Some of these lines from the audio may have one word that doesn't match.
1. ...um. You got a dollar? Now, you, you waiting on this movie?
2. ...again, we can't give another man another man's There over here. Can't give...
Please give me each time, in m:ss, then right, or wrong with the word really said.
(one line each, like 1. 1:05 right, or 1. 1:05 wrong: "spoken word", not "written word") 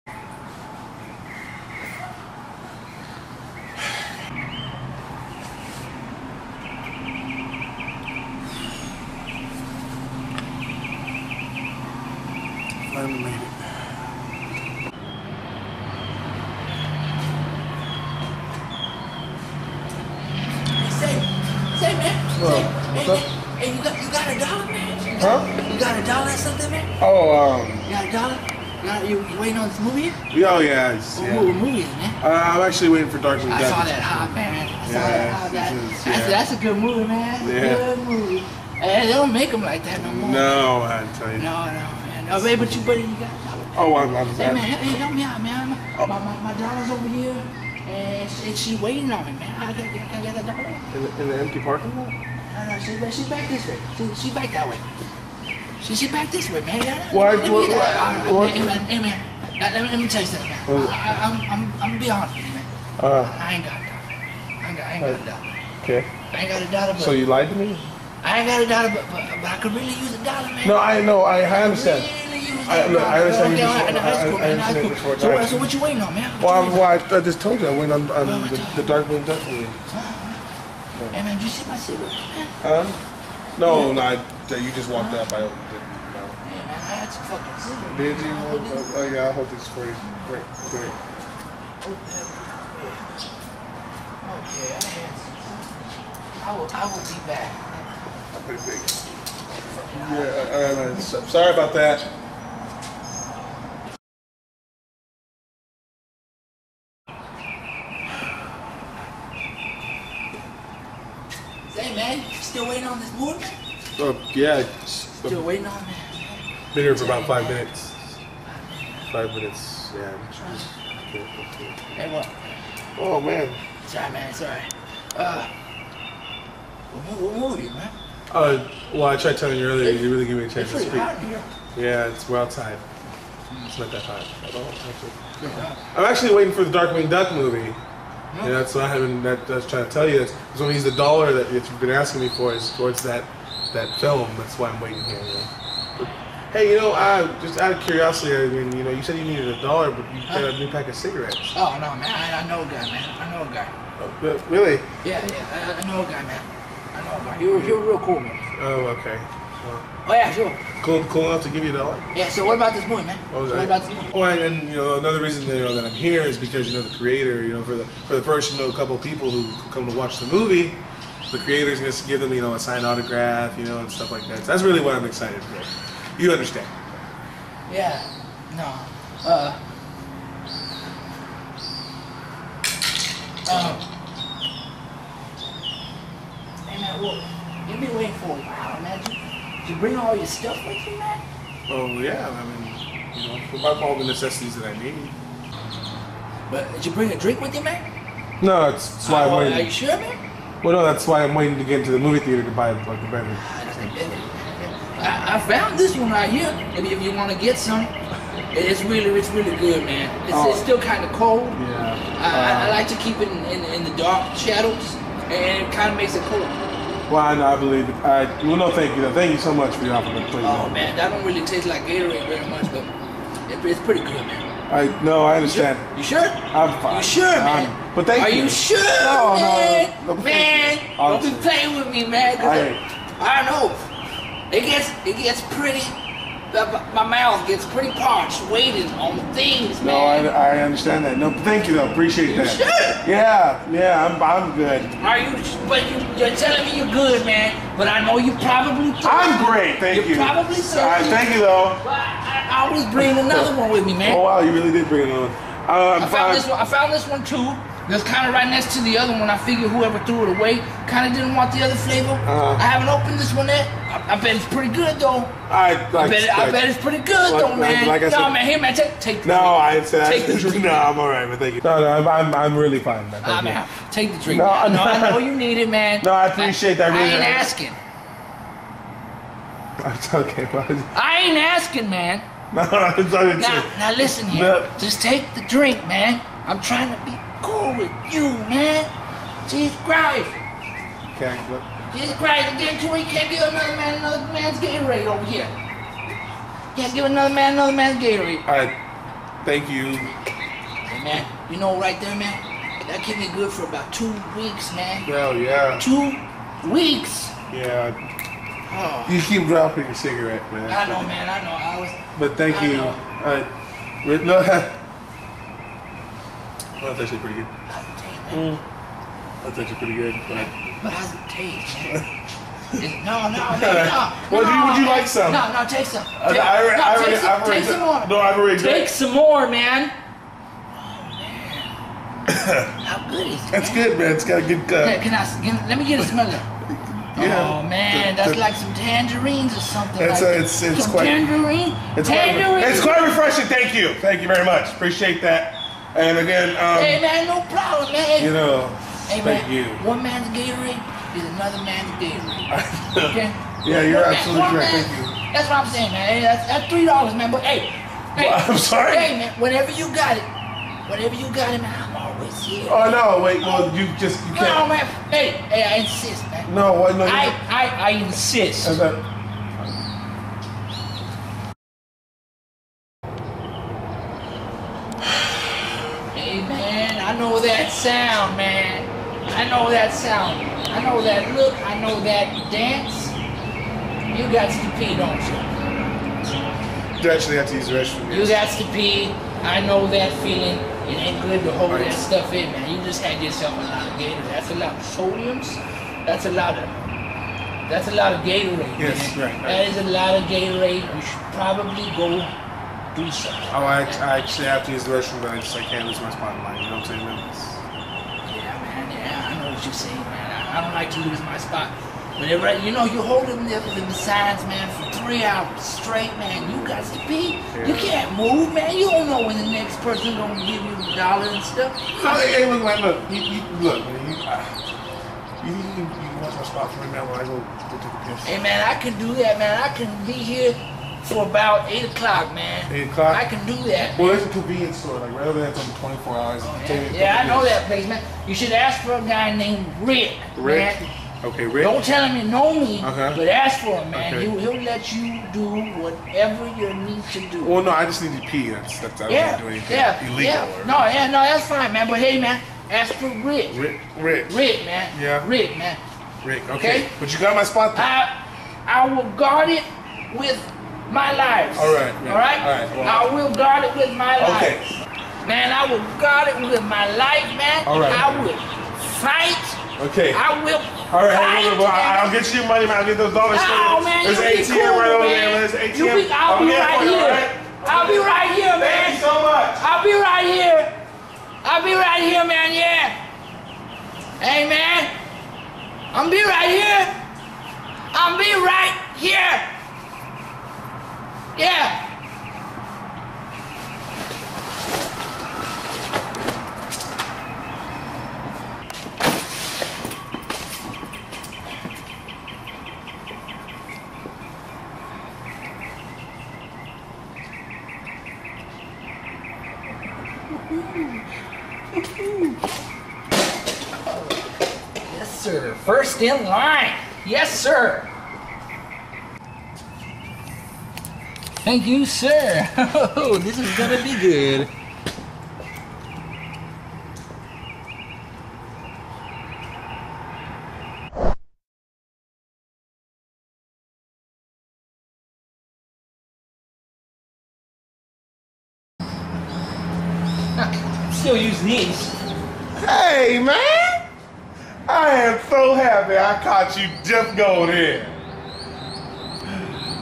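1. 0:27 right
2. 4:52 wrong: "Gatorade", not "There".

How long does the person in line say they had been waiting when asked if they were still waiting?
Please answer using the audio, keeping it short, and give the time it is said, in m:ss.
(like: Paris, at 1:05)
five minutes, at 1:57.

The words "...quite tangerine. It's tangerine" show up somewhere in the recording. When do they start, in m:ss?
5:40.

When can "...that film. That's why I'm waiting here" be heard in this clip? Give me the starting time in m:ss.
2:23.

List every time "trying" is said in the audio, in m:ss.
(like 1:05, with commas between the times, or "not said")
2:19, 4:46.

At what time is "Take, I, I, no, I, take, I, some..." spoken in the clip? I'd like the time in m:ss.
5:26.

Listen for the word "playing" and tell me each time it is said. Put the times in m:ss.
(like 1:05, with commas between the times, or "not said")
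3:51.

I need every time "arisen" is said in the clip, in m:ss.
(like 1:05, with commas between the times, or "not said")
not said.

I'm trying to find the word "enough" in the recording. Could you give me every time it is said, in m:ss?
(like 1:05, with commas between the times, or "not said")
2:41.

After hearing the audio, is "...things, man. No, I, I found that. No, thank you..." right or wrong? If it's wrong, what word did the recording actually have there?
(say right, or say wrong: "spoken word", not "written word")
wrong: "understand", not "found".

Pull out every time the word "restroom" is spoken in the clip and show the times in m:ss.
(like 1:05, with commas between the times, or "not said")
6:27, 6:44.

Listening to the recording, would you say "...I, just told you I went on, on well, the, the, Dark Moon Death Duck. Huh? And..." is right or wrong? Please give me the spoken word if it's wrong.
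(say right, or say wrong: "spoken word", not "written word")
wrong: "Movie", not "Duck".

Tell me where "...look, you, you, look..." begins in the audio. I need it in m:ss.
7:02.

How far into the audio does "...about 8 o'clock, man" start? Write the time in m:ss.
7:11.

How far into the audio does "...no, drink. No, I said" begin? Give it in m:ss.
4:29.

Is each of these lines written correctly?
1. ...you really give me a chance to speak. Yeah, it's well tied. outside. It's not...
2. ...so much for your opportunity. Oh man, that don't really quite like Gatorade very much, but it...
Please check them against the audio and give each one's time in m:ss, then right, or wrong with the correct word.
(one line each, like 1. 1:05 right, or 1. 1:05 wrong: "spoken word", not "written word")
1. 2:09 right
2. 3:39 wrong: "taste", not "quite".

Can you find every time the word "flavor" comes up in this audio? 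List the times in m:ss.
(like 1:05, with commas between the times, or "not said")
4:21.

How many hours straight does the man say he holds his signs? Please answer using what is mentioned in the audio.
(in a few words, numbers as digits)
3 hours.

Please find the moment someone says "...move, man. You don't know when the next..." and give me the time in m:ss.
6:58.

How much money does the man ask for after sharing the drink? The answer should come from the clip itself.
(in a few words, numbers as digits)
3 dollars.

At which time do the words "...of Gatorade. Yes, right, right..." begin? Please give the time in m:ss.
6:38.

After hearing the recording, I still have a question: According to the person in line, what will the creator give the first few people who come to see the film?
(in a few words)
signed autograph.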